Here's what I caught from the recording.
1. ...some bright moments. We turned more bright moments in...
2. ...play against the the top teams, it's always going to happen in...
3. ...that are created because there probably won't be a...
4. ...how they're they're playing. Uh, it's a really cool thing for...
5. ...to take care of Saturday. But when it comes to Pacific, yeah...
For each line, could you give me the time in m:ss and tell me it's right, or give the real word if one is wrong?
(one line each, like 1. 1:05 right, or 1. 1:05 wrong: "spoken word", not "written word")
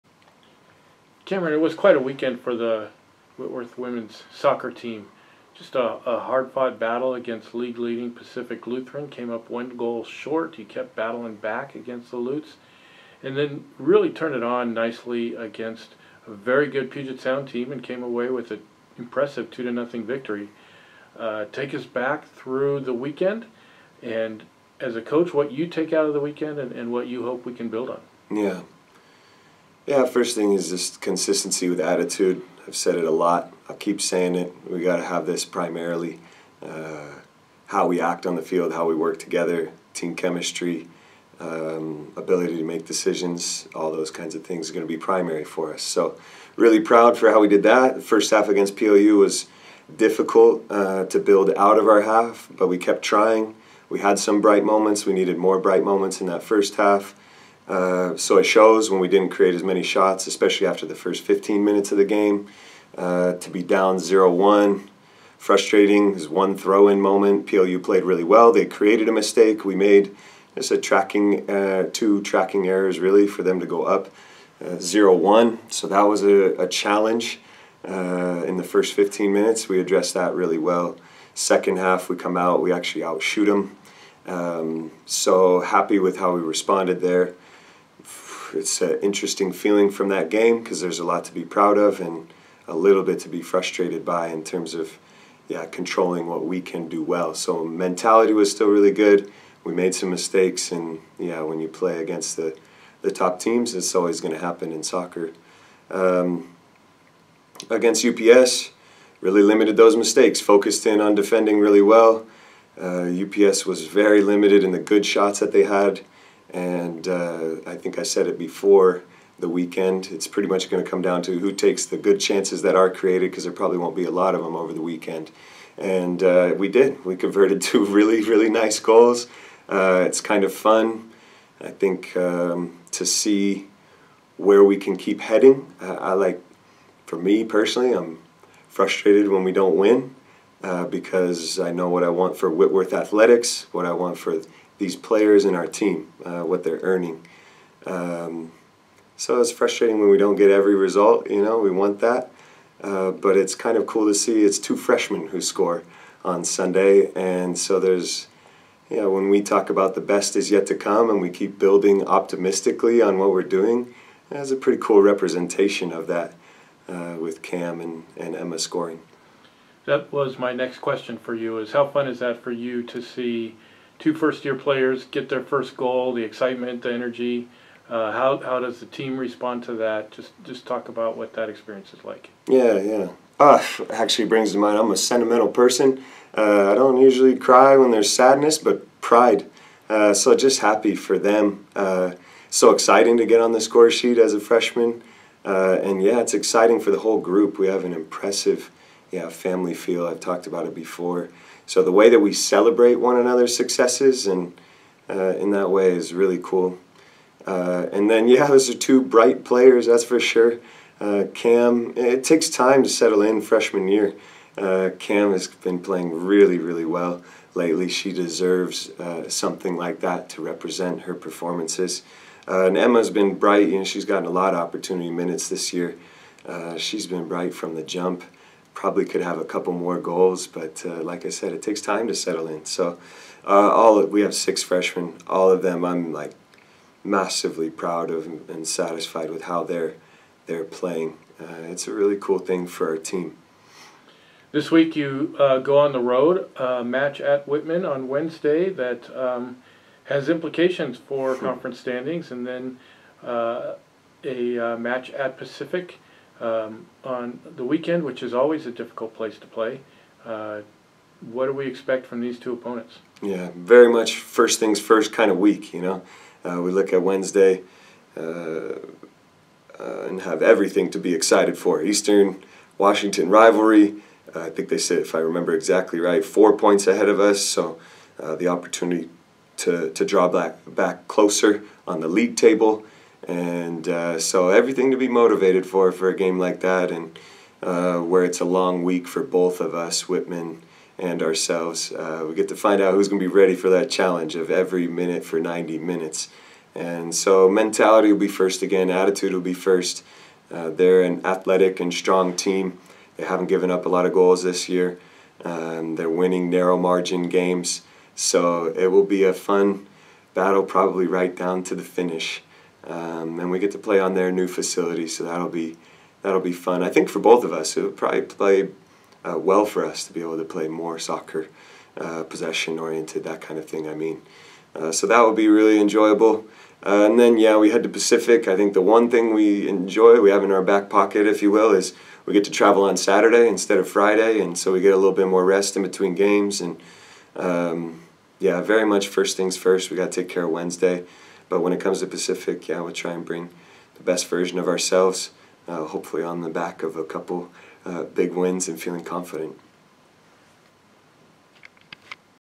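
1. 0:54 wrong: "needed", not "turned"
2. 1:41 right
3. 2:02 right
4. 3:59 right
5. 5:40 wrong: "Wednesday", not "Saturday".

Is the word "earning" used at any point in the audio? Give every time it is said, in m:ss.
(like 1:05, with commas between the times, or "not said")
2:26.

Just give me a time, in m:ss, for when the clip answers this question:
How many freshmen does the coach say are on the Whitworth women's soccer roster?
3:54.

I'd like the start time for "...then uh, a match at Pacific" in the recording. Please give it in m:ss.
4:12.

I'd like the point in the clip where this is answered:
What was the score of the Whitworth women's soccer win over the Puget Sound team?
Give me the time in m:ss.
0:19.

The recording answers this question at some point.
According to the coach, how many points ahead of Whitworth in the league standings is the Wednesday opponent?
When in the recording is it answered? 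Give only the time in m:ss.
4:36.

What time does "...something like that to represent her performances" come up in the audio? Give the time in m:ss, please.
3:39.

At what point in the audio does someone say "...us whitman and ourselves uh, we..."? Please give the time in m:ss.
4:49.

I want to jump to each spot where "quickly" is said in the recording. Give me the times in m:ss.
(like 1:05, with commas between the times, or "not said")
not said.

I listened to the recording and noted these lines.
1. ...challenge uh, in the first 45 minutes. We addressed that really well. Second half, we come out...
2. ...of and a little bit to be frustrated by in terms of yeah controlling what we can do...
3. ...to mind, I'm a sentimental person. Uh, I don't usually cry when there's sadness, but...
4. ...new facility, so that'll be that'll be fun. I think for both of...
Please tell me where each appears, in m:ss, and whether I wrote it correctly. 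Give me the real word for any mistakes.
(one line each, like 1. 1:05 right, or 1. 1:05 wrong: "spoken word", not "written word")
1. 1:16 wrong: "15", not "45"
2. 1:31 right
3. 3:04 right
4. 5:14 right.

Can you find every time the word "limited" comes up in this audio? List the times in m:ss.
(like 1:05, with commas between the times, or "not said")
1:49, 1:54.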